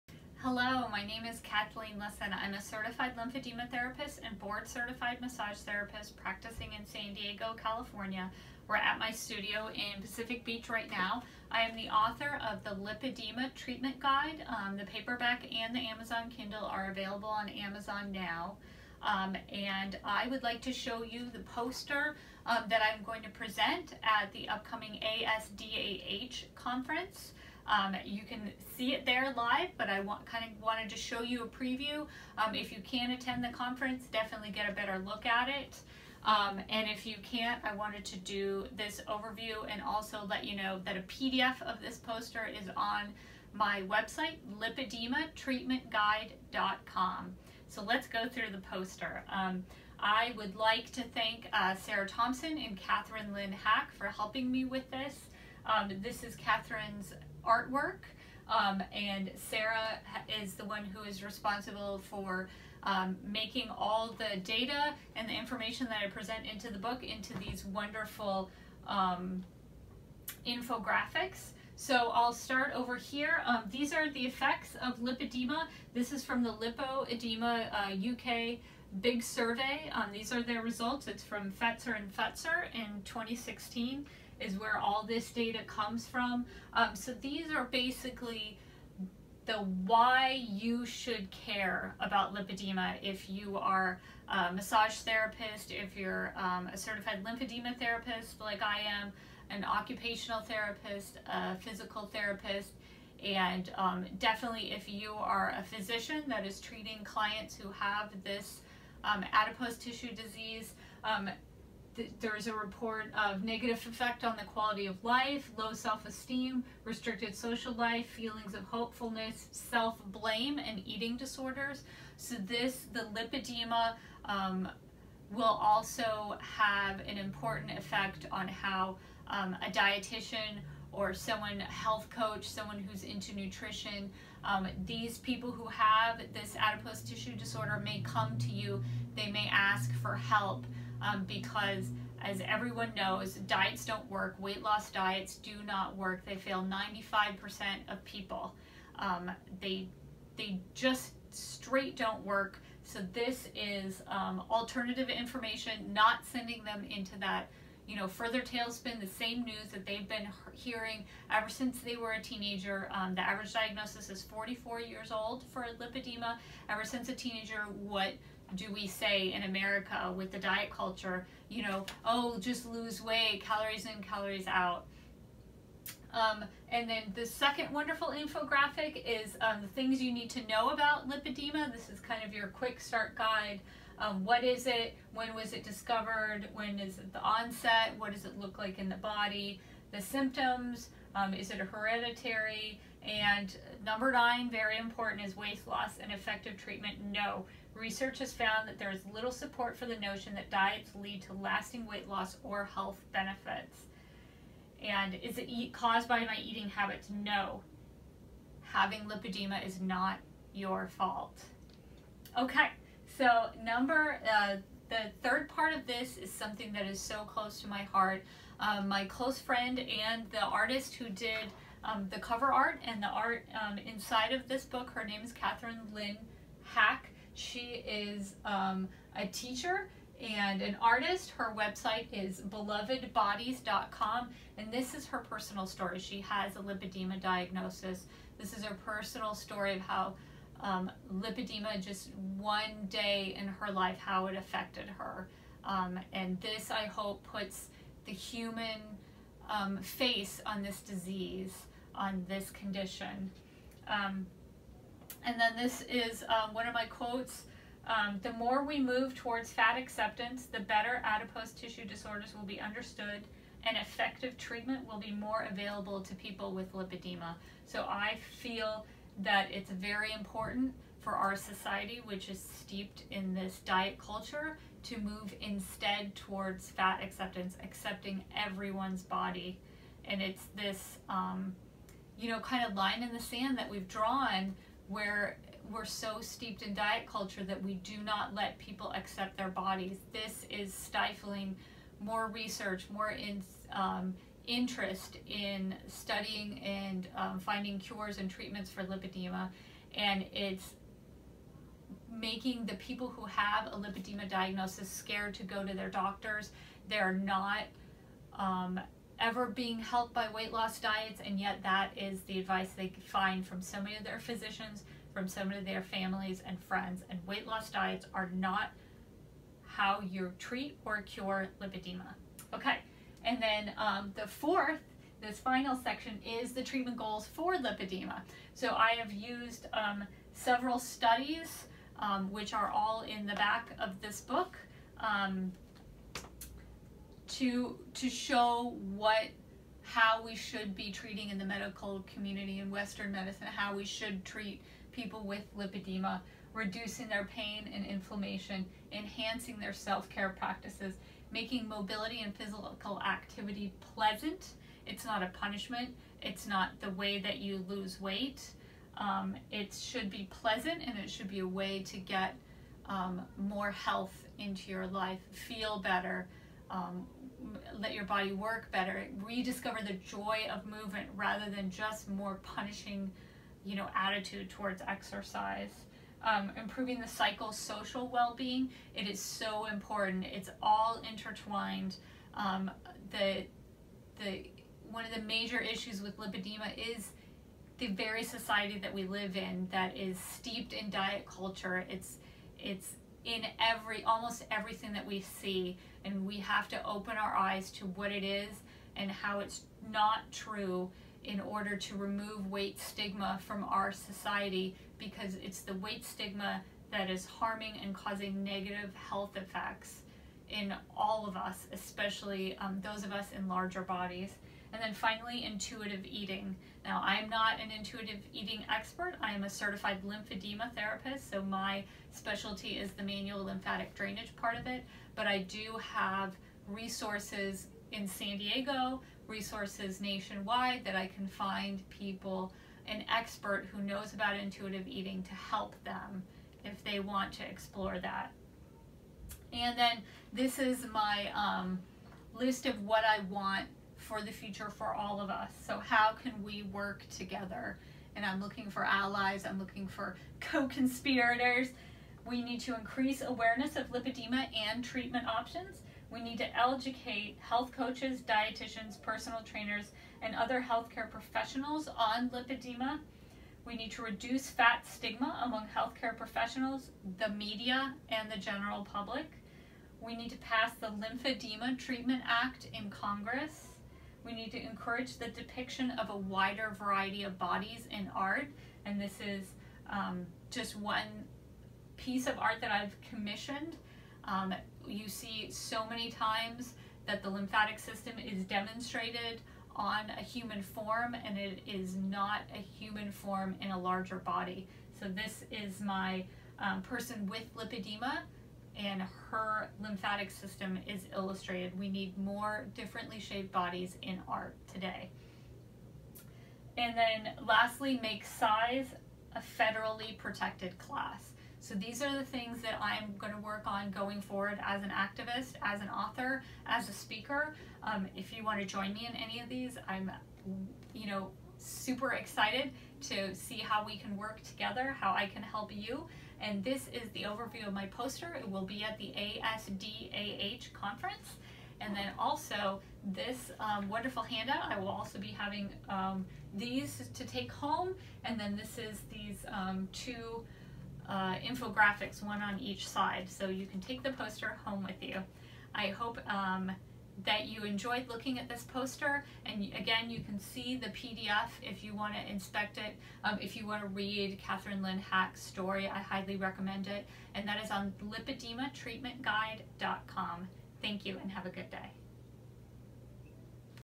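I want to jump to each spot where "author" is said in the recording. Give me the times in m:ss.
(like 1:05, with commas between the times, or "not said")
0:11, 8:35.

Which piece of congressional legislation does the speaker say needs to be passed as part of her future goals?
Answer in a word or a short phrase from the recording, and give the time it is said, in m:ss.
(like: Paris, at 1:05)
Lymphedema Treatment Act, at 7:50.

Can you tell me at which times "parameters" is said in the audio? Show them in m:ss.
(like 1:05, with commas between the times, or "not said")
not said.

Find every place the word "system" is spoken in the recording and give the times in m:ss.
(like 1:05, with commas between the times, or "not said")
8:07, 8:20.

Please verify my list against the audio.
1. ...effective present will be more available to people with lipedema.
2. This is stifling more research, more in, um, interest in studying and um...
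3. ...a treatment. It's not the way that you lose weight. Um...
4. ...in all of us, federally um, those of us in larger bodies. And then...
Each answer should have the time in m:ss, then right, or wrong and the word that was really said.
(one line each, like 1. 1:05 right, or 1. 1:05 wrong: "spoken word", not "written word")
1. 4:23 wrong: "treatment", not "present"
2. 4:50 right
3. 5:55 wrong: "punishment", not "treatment"
4. 6:50 wrong: "especially", not "federally".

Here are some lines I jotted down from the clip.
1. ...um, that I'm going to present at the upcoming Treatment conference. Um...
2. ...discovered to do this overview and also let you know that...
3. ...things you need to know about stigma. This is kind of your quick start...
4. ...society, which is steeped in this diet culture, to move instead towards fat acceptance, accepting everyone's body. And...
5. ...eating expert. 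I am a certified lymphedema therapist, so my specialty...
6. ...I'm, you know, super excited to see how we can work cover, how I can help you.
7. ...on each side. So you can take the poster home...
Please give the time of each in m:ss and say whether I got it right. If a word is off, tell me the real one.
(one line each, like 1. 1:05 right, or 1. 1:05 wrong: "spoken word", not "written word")
1. 0:22 wrong: "ASDAH", not "Treatment"
2. 0:37 wrong: "wanted", not "discovered"
3. 2:59 wrong: "lipedema", not "stigma"
4. 4:31 right
5. 6:58 right
6. 8:39 wrong: "together", not "cover"
7. 9:02 right.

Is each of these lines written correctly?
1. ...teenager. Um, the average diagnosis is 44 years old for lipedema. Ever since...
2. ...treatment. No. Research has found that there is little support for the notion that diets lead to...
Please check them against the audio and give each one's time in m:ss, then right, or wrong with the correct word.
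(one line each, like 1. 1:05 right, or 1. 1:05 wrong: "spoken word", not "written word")
1. 2:42 right
2. 3:16 right.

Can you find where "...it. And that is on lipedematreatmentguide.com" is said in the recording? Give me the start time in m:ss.
9:16.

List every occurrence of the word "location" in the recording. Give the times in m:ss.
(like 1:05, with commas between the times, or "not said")
not said.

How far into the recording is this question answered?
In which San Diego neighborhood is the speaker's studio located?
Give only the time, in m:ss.
0:10.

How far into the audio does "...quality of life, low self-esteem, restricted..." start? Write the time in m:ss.
1:54.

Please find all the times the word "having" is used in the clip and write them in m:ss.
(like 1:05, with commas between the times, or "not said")
3:28, 8:55.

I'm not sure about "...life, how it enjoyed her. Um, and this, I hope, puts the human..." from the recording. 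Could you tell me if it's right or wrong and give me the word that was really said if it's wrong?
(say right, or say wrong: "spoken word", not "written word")
wrong: "affected", not "enjoyed".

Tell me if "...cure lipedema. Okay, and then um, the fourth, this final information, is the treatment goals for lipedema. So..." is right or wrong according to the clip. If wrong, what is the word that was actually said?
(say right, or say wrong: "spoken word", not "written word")
wrong: "section", not "information".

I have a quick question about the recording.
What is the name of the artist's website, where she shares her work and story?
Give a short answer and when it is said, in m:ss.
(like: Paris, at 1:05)
belovedbodies.com, at 3:52.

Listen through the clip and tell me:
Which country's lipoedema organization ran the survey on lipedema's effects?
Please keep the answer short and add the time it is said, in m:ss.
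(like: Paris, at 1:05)
UK, at 1:16.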